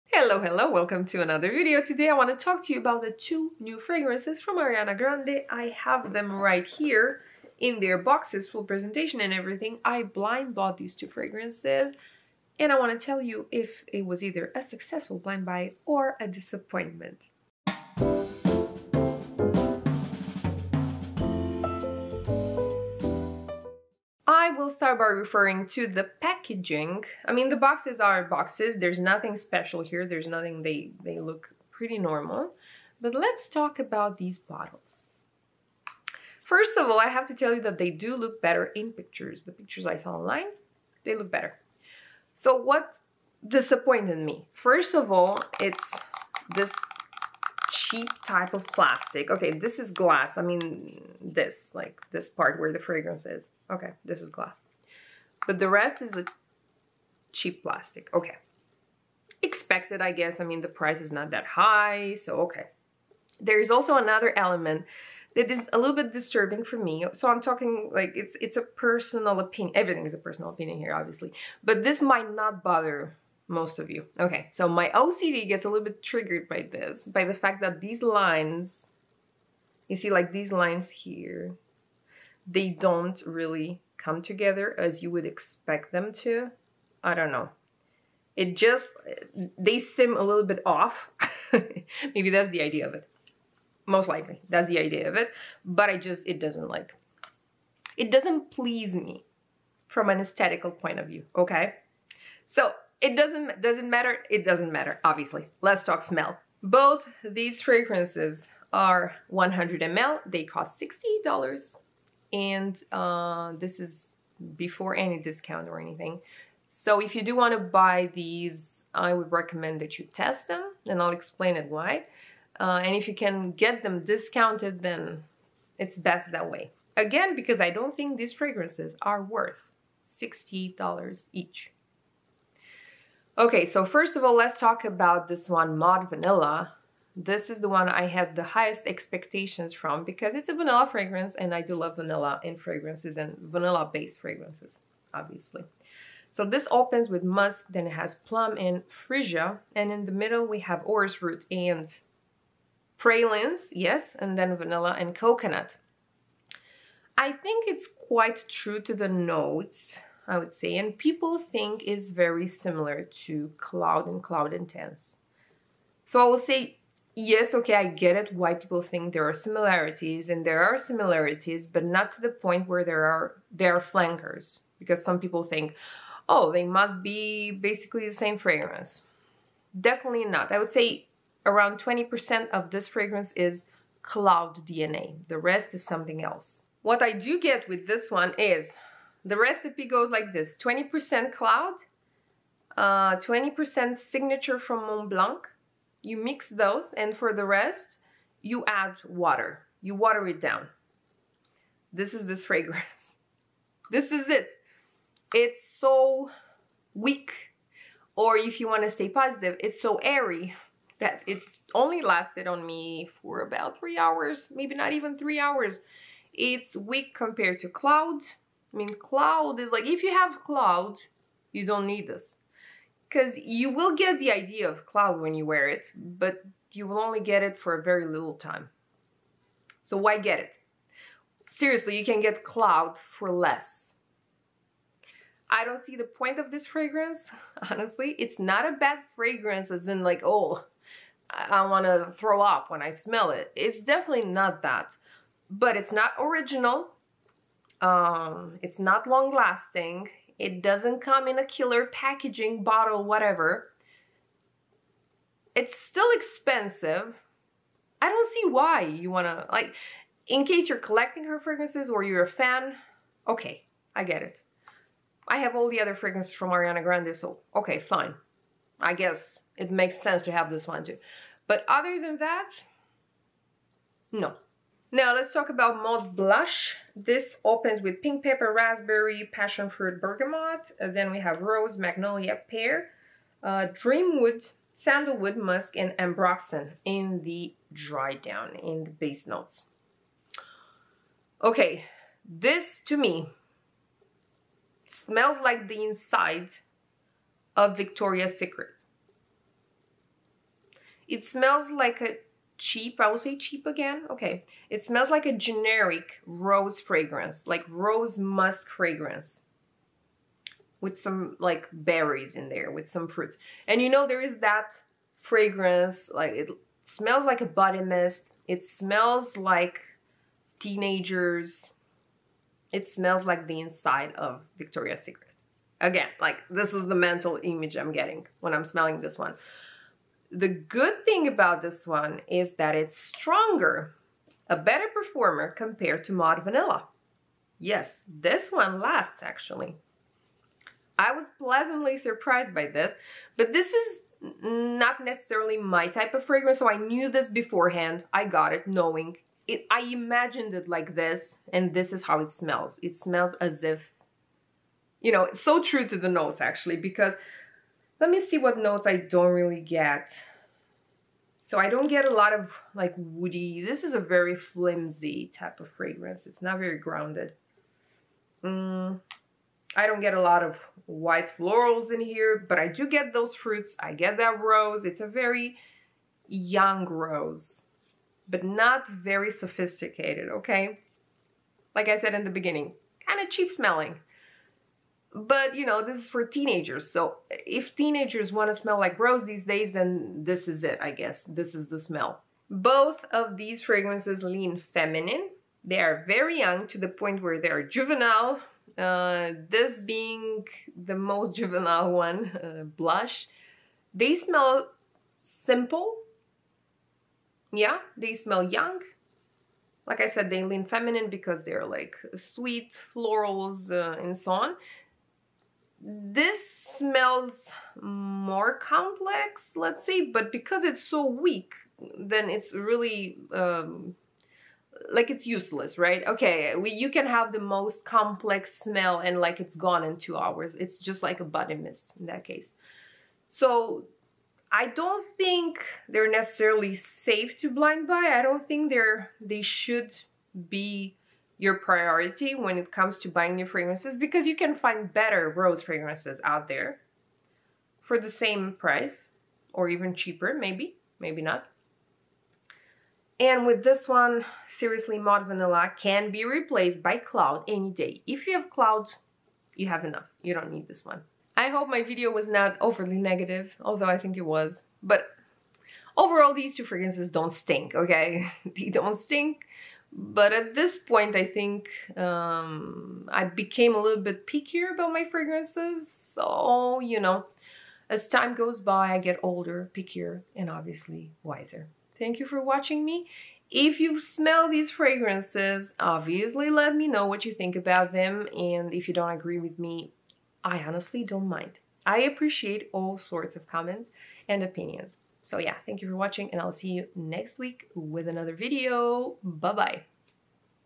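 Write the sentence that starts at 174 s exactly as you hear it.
Because some people think, oh, they must be basically the same fragrance.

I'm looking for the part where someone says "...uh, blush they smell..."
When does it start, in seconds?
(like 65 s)
402 s.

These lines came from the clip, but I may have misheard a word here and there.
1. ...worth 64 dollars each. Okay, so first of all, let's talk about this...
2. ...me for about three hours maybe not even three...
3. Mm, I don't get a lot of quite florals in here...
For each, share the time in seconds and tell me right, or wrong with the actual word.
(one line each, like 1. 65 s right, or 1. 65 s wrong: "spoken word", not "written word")
1. 129 s wrong: "60", not "64"
2. 212 s right
3. 368 s wrong: "white", not "quite".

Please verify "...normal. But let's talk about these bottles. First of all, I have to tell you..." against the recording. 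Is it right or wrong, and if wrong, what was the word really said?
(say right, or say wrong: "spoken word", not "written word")
right.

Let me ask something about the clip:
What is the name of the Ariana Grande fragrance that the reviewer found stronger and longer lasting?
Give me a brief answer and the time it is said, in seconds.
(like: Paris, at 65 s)
Mod Blush, at 275 s.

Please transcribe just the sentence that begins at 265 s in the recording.
I have all the other fragrances from Ariana Grande, so okay, fine.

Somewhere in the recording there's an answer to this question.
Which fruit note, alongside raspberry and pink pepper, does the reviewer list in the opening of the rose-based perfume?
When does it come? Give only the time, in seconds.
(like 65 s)
279 s.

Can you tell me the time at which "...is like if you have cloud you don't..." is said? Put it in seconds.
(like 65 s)
219 s.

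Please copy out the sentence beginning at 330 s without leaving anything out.
The good thing about this one is that it's stronger, a better performer compared to Mod Vanilla.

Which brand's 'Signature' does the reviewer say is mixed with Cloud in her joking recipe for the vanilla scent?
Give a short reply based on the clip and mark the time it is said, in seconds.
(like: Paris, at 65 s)
Mont Blanc, at 194 s.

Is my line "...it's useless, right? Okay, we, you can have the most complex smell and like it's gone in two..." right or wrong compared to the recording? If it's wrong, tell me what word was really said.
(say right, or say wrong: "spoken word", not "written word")
right.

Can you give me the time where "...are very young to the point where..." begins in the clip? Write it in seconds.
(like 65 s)
395 s.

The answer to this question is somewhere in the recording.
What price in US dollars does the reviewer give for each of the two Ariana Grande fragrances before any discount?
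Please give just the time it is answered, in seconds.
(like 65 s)
110 s.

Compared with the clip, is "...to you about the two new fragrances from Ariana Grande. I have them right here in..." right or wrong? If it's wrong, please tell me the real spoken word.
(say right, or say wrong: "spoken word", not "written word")
right.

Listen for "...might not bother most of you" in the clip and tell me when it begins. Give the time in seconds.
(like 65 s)
72 s.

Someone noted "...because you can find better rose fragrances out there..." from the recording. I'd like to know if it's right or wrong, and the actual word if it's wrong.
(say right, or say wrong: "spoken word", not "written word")
right.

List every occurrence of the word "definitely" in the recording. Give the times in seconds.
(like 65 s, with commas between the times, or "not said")
179 s, 243 s.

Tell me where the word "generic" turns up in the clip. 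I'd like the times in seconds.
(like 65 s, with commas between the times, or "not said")
305 s.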